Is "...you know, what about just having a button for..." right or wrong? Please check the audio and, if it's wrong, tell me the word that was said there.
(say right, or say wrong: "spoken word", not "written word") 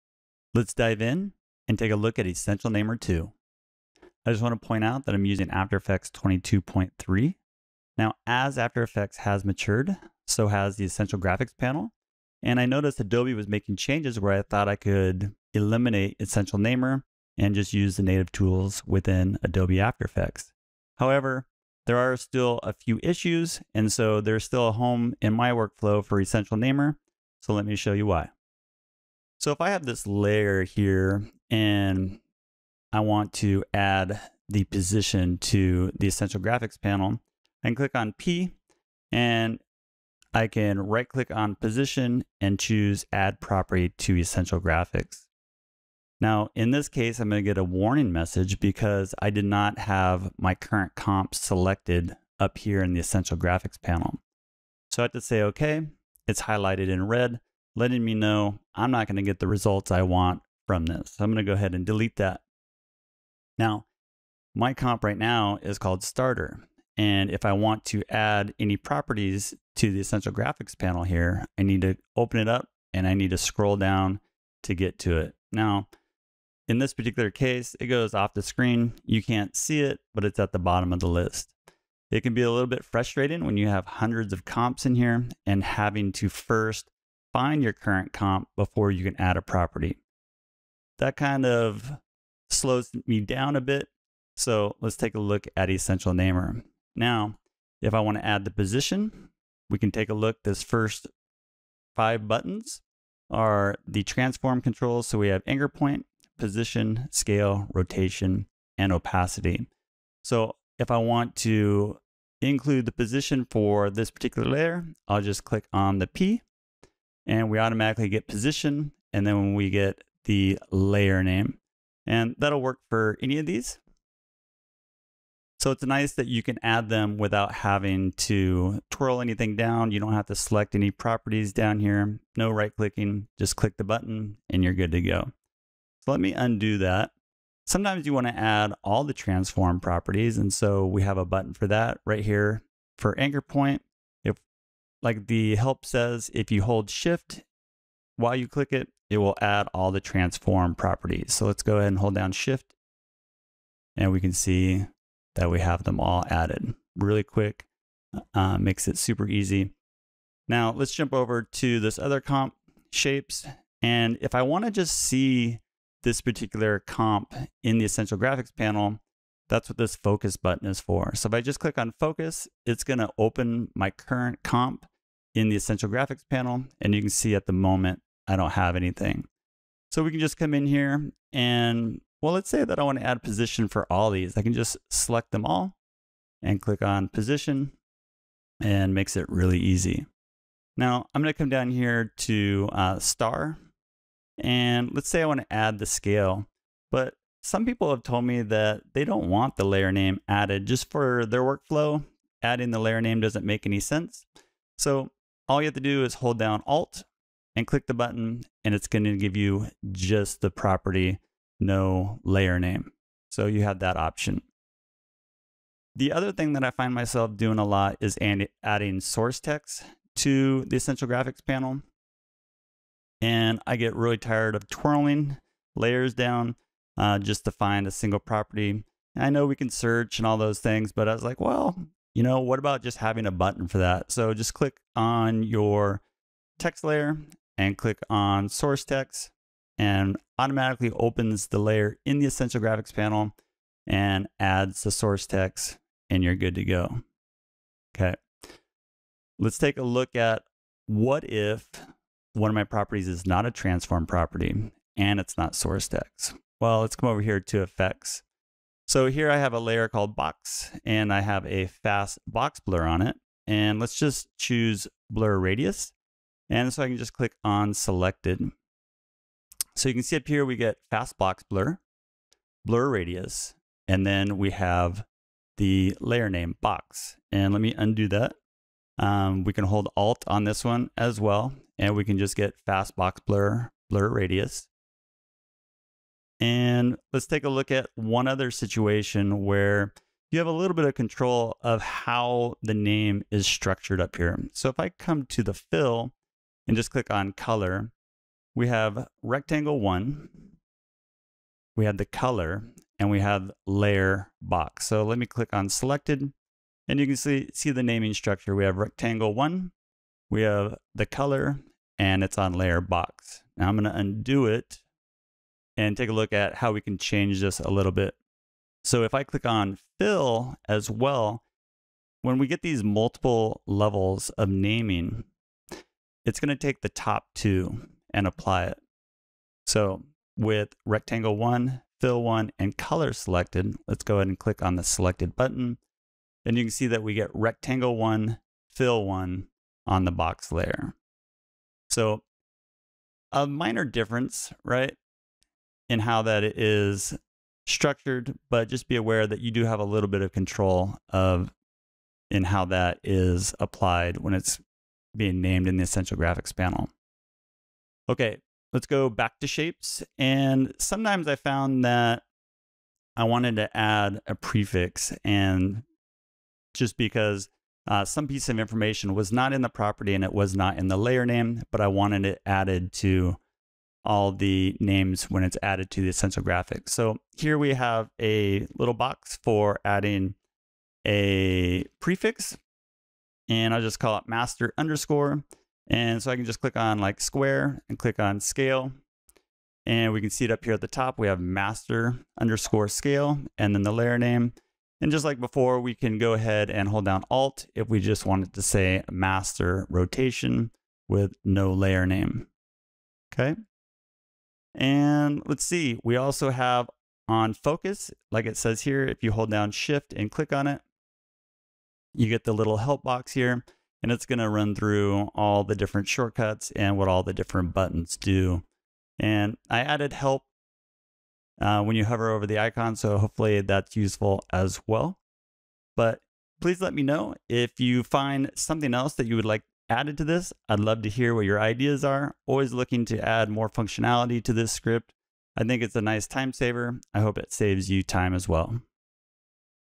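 right.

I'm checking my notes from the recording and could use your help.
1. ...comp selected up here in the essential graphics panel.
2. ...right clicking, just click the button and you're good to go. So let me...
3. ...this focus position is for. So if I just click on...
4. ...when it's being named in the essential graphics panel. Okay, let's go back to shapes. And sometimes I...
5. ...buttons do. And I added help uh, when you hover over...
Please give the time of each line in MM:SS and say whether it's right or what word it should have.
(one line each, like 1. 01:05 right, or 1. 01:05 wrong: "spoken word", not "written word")
1. 00:50 right
2. 02:12 right
3. 02:49 wrong: "button", not "position"
4. 05:54 right
5. 06:57 right.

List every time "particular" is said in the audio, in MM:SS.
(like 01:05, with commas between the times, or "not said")
01:16, 01:54, 02:46.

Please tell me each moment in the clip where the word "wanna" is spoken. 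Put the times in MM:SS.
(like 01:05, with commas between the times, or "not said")
02:18, 02:44.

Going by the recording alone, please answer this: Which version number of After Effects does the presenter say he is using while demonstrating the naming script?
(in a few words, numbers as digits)
22.3.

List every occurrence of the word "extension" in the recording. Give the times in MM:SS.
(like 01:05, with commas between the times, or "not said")
not said.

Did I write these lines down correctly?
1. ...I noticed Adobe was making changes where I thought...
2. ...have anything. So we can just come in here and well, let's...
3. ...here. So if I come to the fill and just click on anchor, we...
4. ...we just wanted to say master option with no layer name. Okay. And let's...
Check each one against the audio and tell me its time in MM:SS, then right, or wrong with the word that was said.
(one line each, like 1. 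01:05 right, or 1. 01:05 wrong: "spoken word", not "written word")
1. 00:12 right
2. 02:58 right
3. 04:54 wrong: "color", not "anchor"
4. 06:37 wrong: "rotation", not "option".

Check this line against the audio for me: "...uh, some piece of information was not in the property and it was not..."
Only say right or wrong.
right.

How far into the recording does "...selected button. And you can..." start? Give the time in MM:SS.
05:34.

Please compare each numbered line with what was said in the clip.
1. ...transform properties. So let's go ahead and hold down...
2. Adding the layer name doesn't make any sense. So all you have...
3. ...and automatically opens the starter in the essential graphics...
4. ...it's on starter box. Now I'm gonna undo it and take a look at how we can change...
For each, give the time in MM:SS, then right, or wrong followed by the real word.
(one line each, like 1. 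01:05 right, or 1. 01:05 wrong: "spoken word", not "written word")
1. 02:29 right
2. 03:22 right
3. 03:59 wrong: "layer", not "starter"
4. 05:12 wrong: "layer", not "starter".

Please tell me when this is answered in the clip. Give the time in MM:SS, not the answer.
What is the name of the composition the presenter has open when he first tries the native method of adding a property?
01:06.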